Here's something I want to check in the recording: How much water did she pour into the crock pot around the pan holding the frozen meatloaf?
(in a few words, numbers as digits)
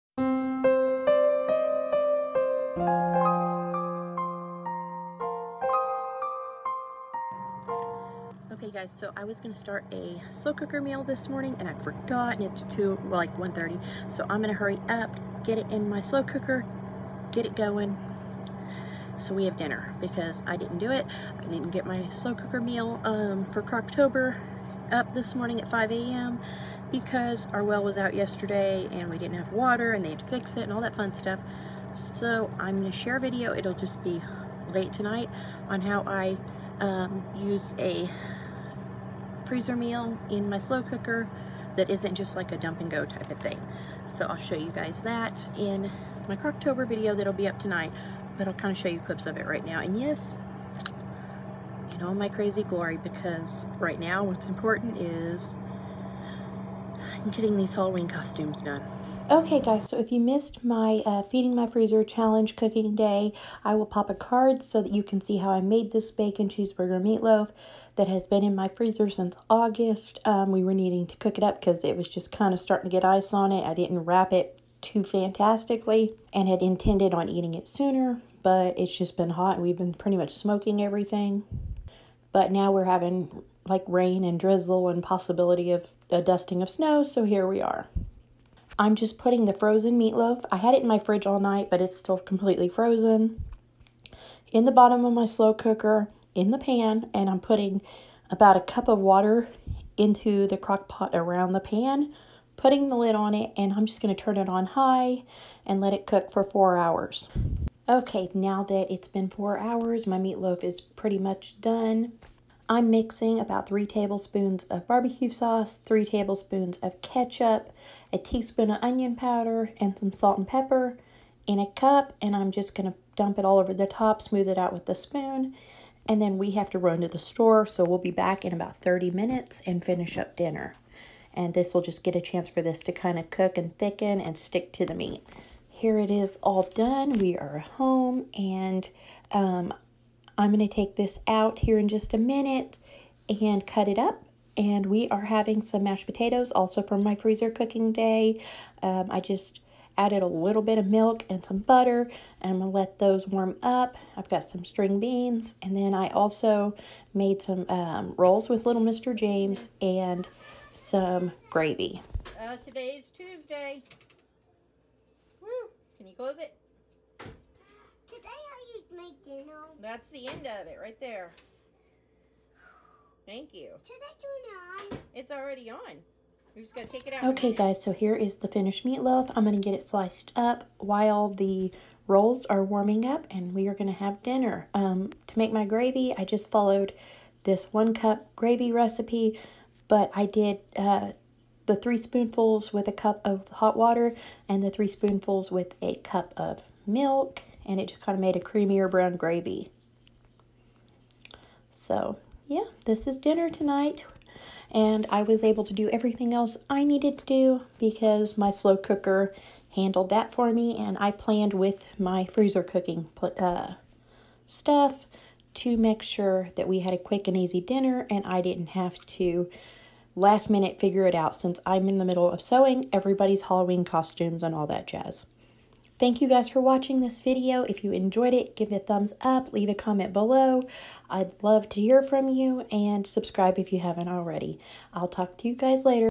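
about a cup.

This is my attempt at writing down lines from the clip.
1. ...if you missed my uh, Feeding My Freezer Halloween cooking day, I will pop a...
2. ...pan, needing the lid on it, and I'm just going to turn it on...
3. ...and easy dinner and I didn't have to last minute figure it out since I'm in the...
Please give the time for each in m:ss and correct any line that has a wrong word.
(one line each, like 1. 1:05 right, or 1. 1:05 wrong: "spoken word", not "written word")
1. 0:59 wrong: "Challenge", not "Halloween"
2. 1:41 wrong: "putting", not "needing"
3. 3:37 right.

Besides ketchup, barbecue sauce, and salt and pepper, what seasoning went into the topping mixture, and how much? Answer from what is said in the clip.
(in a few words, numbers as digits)
1 teaspoon of onion powder.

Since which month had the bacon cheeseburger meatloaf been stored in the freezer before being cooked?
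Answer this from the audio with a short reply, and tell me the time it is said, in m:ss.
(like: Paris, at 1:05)
August, at 1:09.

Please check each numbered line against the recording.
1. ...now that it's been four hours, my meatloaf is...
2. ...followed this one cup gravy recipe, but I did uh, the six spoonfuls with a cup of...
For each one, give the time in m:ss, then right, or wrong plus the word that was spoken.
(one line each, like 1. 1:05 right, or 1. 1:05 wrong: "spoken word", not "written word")
1. 1:48 right
2. 3:06 wrong: "three", not "six".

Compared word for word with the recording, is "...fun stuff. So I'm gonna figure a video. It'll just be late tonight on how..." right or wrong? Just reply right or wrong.
wrong.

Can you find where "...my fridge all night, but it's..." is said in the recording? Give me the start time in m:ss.
1:30.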